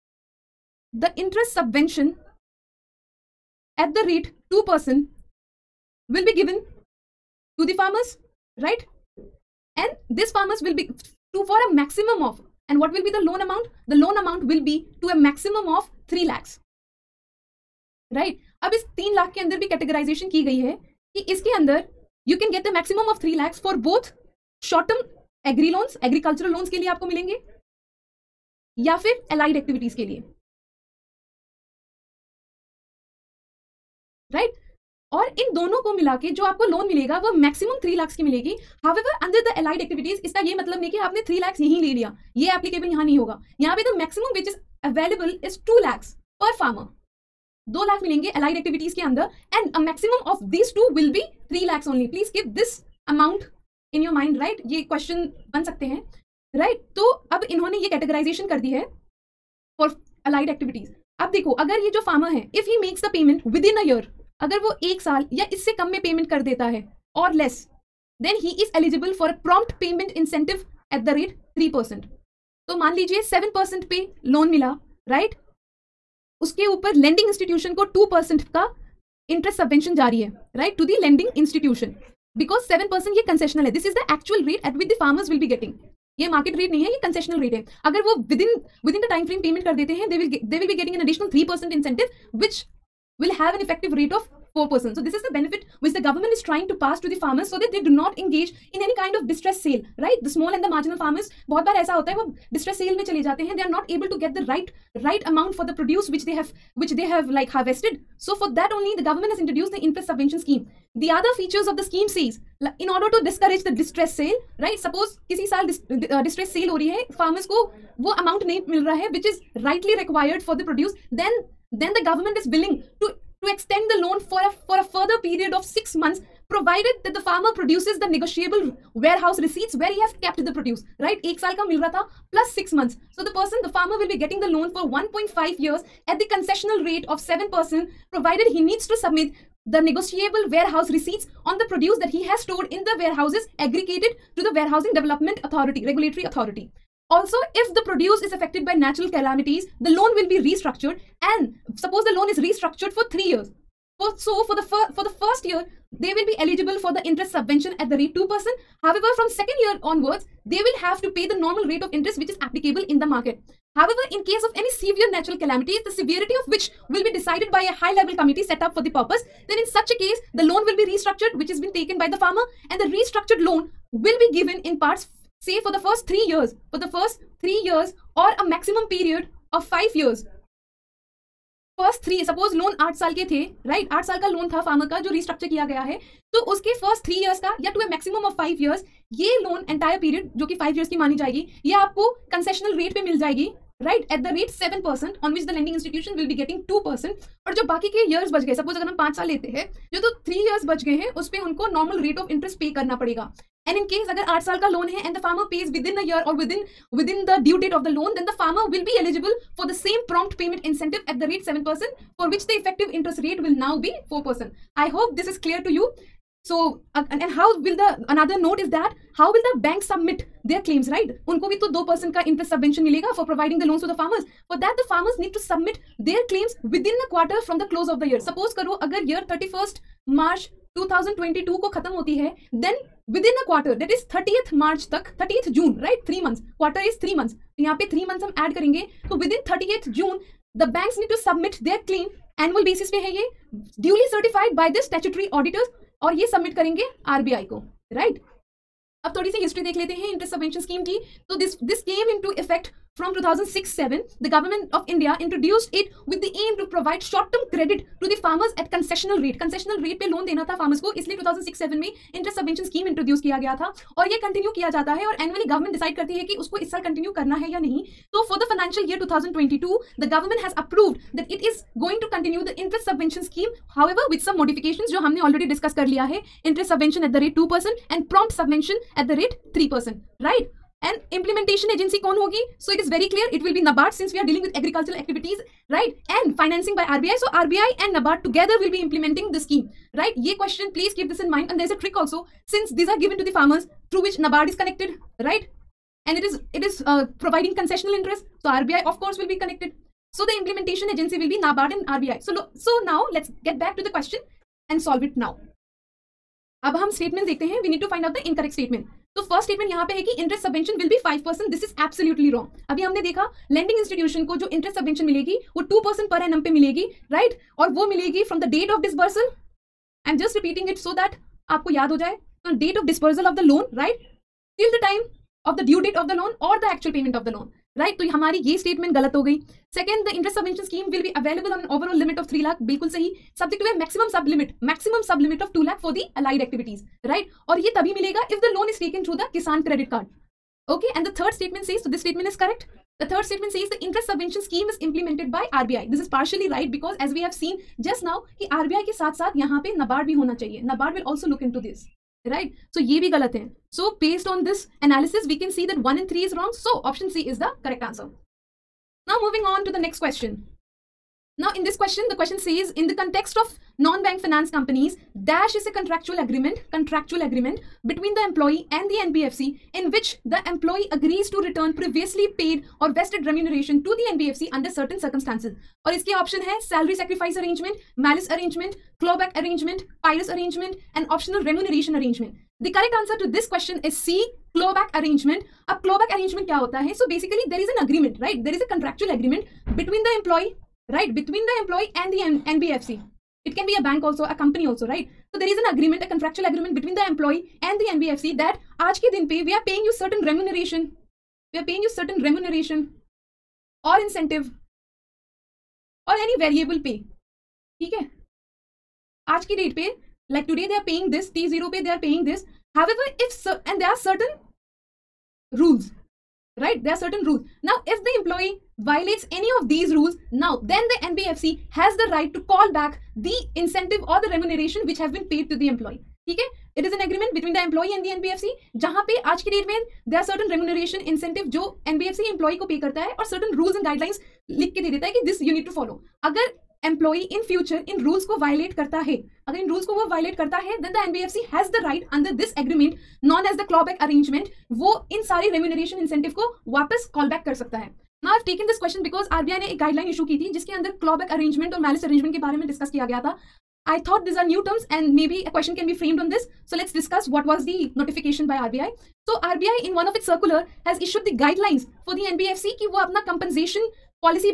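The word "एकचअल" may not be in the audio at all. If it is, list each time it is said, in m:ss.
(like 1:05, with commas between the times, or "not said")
1:24, 5:26.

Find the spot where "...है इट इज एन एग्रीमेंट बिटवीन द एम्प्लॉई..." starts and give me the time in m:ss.
7:06.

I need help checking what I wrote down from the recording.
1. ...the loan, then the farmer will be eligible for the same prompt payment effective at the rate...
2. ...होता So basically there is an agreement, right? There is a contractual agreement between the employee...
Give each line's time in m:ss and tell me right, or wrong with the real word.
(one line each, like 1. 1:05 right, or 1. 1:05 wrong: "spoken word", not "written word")
1. 3:27 wrong: "incentive", not "effective"
2. 6:26 right.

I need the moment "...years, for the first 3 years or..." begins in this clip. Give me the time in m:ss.
2:56.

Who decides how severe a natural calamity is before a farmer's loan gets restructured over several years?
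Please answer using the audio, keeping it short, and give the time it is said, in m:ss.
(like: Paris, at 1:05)
high level committee, at 2:47.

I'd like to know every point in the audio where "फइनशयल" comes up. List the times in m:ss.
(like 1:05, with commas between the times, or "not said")
4:28.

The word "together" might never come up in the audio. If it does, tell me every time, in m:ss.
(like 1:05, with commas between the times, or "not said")
4:48.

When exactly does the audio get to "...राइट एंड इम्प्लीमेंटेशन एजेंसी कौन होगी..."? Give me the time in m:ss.
4:40.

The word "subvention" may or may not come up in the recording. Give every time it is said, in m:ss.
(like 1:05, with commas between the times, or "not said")
0:01, 1:50, 2:37, 3:42, 5:44.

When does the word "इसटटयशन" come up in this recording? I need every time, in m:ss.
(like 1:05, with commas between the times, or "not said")
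1:17, 1:21, 3:15, 5:13.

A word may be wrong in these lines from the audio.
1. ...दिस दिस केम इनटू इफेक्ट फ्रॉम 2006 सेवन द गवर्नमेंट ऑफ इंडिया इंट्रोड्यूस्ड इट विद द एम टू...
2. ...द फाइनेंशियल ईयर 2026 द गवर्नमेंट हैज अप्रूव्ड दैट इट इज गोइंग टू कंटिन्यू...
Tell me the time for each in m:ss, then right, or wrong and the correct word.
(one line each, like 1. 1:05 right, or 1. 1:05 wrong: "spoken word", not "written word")
1. 4:11 right
2. 4:28 wrong: "2022", not "2026".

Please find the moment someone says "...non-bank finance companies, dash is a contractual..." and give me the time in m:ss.
6:03.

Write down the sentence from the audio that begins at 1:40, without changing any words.
The small and the marginal farmers, बहुत बार ऐसा होता है वो distress sale में चले जाते हैं.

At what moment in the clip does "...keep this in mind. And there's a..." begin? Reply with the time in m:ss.
4:50.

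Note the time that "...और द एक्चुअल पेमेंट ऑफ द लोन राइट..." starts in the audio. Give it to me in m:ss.
5:26.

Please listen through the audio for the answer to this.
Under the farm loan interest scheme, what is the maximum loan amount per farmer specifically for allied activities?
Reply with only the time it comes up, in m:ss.
0:45.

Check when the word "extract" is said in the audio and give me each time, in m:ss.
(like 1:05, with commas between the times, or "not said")
not said.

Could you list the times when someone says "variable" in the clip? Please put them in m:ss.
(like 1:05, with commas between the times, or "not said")
6:46.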